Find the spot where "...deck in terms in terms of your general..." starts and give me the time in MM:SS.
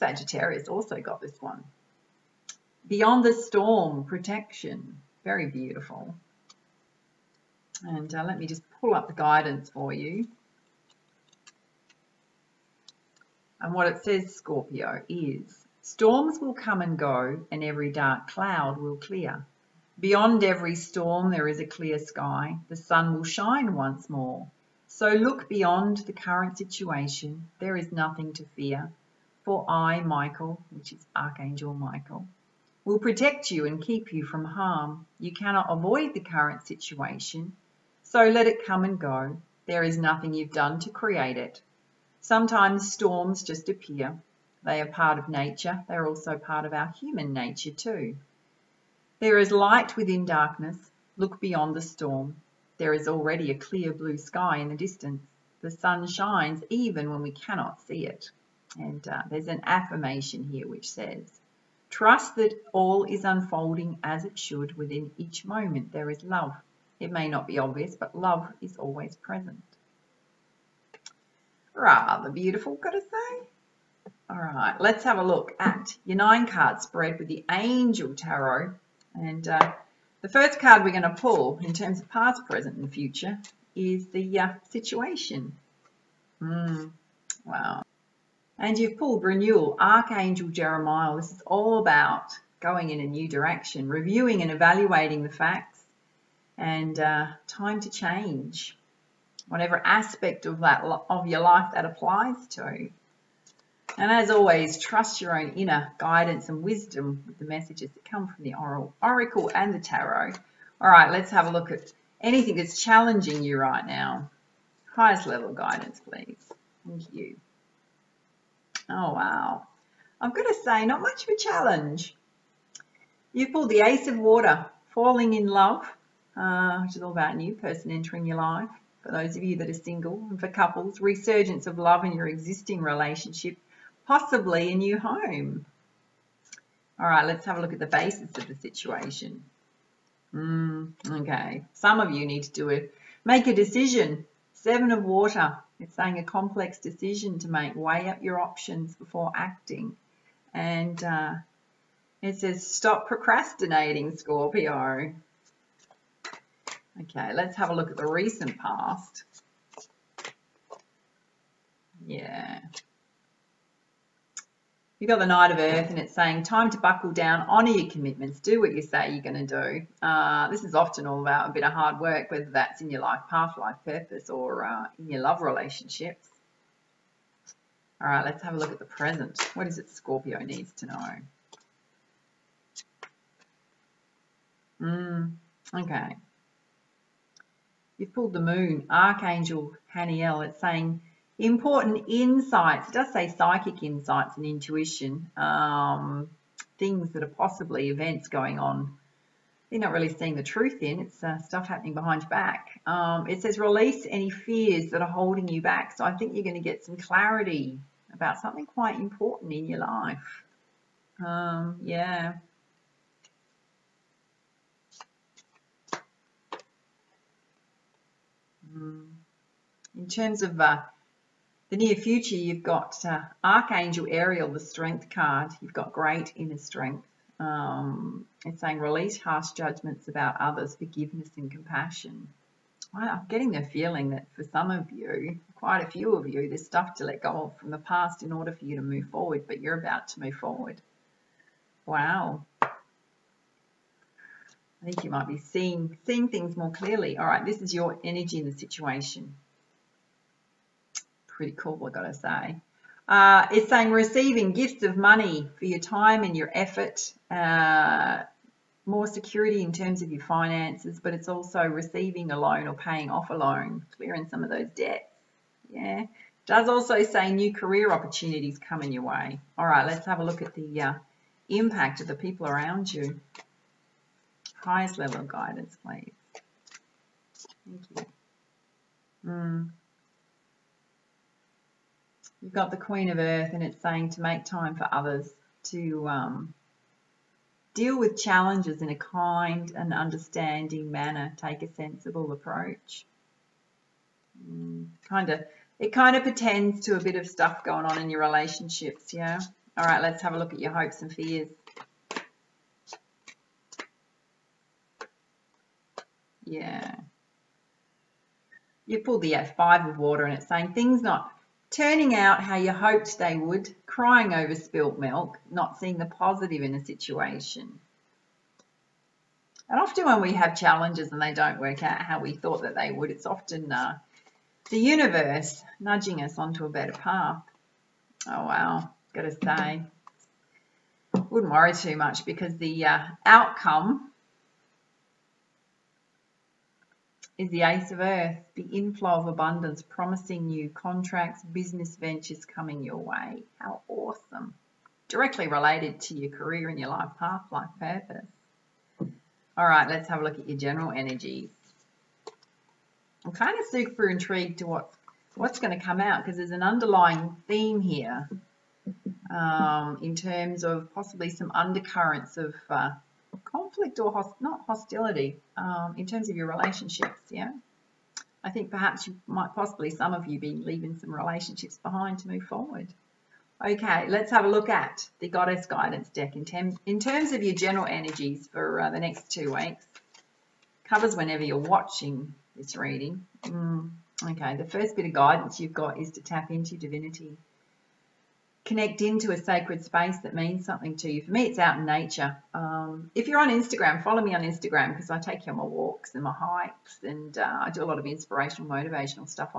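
06:16.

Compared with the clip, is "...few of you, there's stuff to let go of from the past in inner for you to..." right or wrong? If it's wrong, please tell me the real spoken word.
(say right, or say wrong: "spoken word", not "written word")
wrong: "order", not "inner".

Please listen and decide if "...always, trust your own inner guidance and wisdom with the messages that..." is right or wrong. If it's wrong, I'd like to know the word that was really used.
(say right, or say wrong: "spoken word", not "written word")
right.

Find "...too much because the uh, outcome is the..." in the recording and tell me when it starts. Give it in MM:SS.
05:31.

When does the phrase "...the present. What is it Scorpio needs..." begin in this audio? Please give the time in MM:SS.
02:58.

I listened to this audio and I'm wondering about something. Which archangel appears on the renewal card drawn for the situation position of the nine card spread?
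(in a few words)
Archangel Jeremiah.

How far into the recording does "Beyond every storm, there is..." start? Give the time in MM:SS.
00:19.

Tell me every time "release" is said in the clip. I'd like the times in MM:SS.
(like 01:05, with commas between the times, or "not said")
03:23, 03:48.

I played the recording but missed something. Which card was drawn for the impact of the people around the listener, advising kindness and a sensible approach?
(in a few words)
Queen of Earth.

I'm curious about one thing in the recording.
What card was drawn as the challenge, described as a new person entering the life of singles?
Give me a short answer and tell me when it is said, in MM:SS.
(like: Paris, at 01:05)
Ace of Water, at 02:03.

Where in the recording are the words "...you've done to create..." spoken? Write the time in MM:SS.
00:40.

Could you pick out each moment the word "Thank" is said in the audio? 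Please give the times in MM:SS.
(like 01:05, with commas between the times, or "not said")
01:56, 04:37.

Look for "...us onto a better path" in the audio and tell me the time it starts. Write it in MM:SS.
05:26.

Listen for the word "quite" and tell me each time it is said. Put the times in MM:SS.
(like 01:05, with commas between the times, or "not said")
03:28, 03:55.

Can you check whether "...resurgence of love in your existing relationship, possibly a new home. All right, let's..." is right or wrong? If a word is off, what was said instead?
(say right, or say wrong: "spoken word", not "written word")
right.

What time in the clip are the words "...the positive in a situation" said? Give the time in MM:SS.
05:15.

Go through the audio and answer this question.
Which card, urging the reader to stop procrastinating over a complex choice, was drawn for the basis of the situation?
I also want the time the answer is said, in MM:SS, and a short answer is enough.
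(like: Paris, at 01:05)
Seven of Water, at 02:24.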